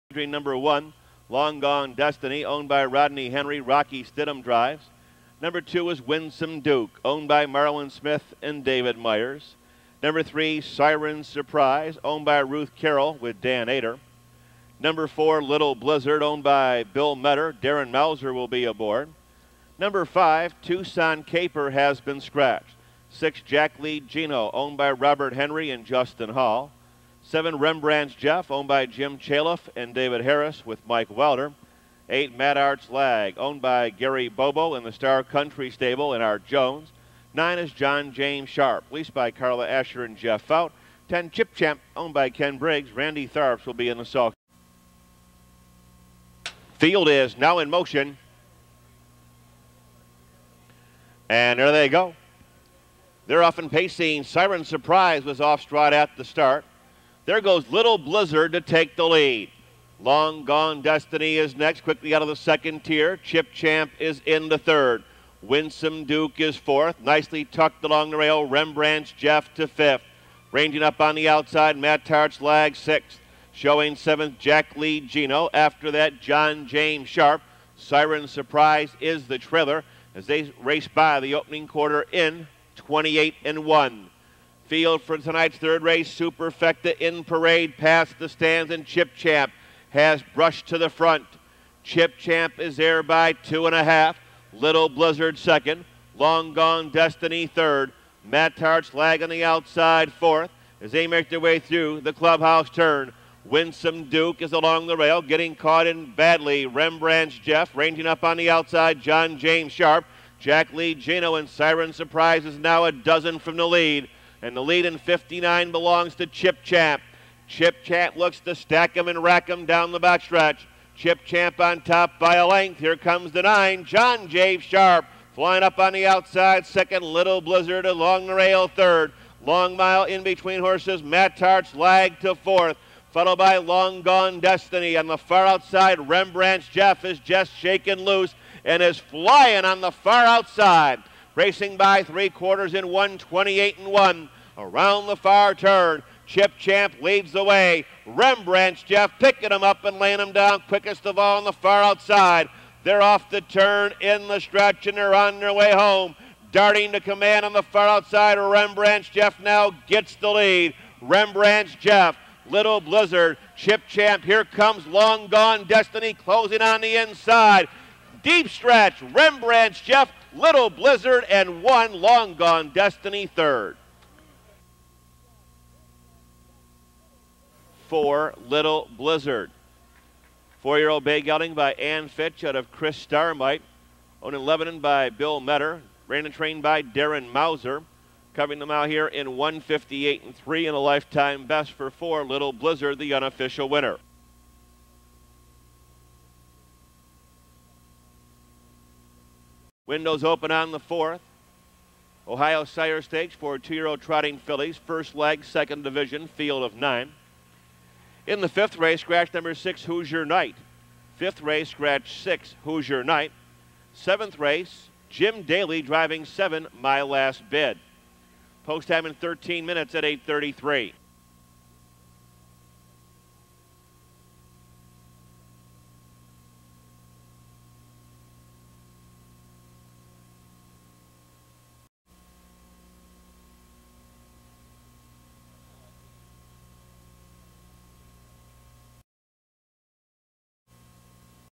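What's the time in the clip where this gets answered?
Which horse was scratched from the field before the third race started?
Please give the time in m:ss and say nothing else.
0:20.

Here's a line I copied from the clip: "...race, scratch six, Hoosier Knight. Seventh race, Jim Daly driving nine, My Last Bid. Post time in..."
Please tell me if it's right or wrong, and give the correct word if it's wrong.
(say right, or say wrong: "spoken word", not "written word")
wrong: "seven", not "nine".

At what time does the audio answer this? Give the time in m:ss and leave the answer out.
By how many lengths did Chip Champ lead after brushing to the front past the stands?
1:33.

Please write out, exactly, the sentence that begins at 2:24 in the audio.
Around the far turn, Chip Champ leads the way.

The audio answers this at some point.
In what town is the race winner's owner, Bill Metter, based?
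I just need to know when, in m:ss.
3:04.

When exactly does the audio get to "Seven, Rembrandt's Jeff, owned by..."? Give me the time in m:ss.
0:27.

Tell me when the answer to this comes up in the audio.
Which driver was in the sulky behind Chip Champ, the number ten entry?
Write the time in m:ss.
0:42.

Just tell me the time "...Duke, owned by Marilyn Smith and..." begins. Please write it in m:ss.
0:06.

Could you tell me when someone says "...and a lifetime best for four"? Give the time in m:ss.
3:10.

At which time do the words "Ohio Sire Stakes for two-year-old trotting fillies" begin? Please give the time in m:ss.
3:22.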